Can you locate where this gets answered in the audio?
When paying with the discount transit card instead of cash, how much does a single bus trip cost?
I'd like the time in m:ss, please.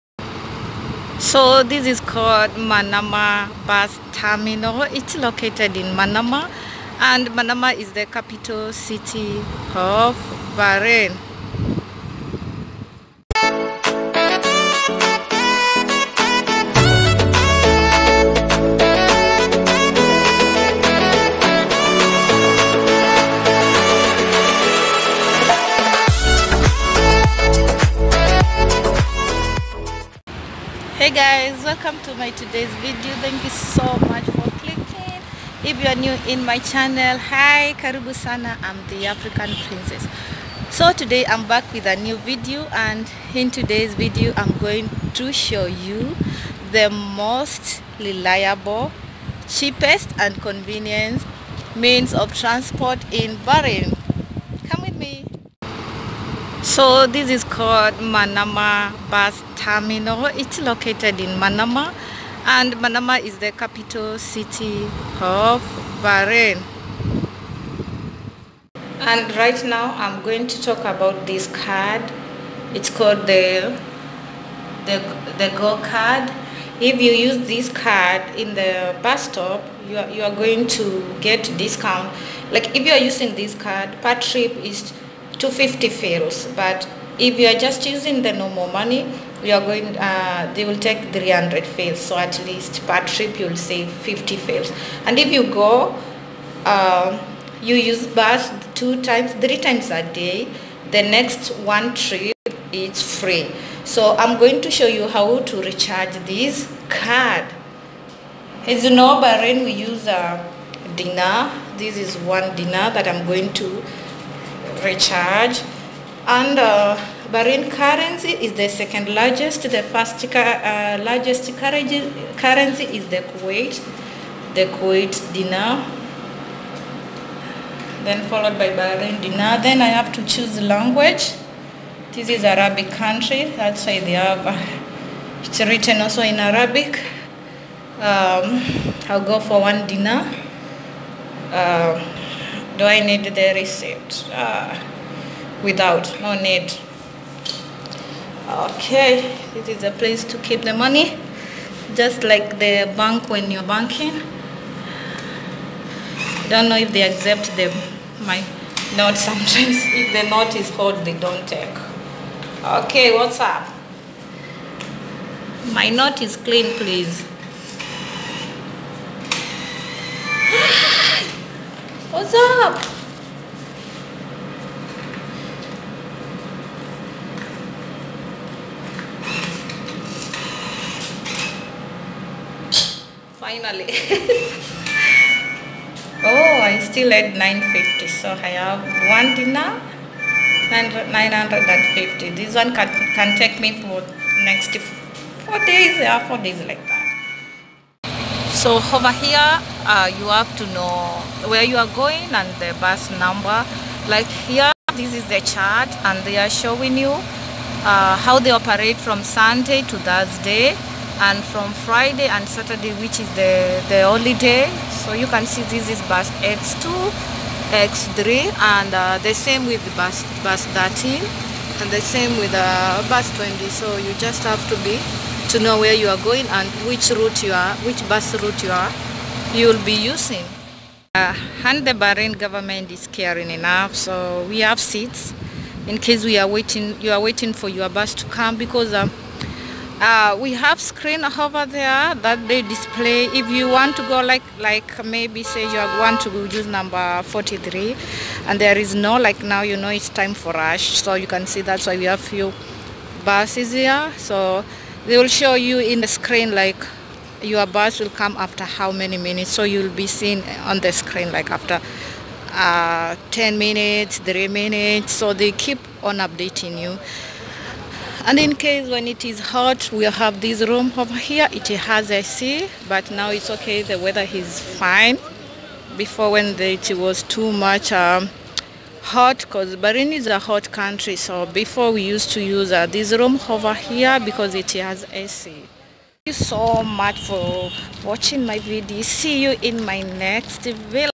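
1:25.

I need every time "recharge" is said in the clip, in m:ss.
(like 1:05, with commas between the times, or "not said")
1:45, 1:54.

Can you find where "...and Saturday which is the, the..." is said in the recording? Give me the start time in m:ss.
3:32.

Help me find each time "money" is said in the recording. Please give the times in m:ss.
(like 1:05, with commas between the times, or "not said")
1:28, 2:30.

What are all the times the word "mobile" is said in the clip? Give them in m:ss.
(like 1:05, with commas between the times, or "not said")
not said.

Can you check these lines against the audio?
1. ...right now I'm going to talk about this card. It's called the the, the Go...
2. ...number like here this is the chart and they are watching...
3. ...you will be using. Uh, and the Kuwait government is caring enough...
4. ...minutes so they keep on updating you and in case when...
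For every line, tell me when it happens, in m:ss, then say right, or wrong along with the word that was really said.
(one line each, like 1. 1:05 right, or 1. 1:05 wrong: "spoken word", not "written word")
1. 1:09 right
2. 3:23 wrong: "showing", not "watching"
3. 3:49 wrong: "Bahrain", not "Kuwait"
4. 4:24 right.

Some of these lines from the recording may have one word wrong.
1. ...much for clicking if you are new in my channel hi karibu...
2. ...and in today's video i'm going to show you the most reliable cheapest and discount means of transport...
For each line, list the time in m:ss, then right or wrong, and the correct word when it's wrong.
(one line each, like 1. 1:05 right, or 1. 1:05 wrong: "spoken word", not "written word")
1. 0:34 right
2. 0:42 wrong: "convenient", not "discount".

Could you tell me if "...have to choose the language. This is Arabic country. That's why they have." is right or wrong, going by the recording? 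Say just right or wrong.
right.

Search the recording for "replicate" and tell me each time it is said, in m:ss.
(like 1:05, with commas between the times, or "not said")
not said.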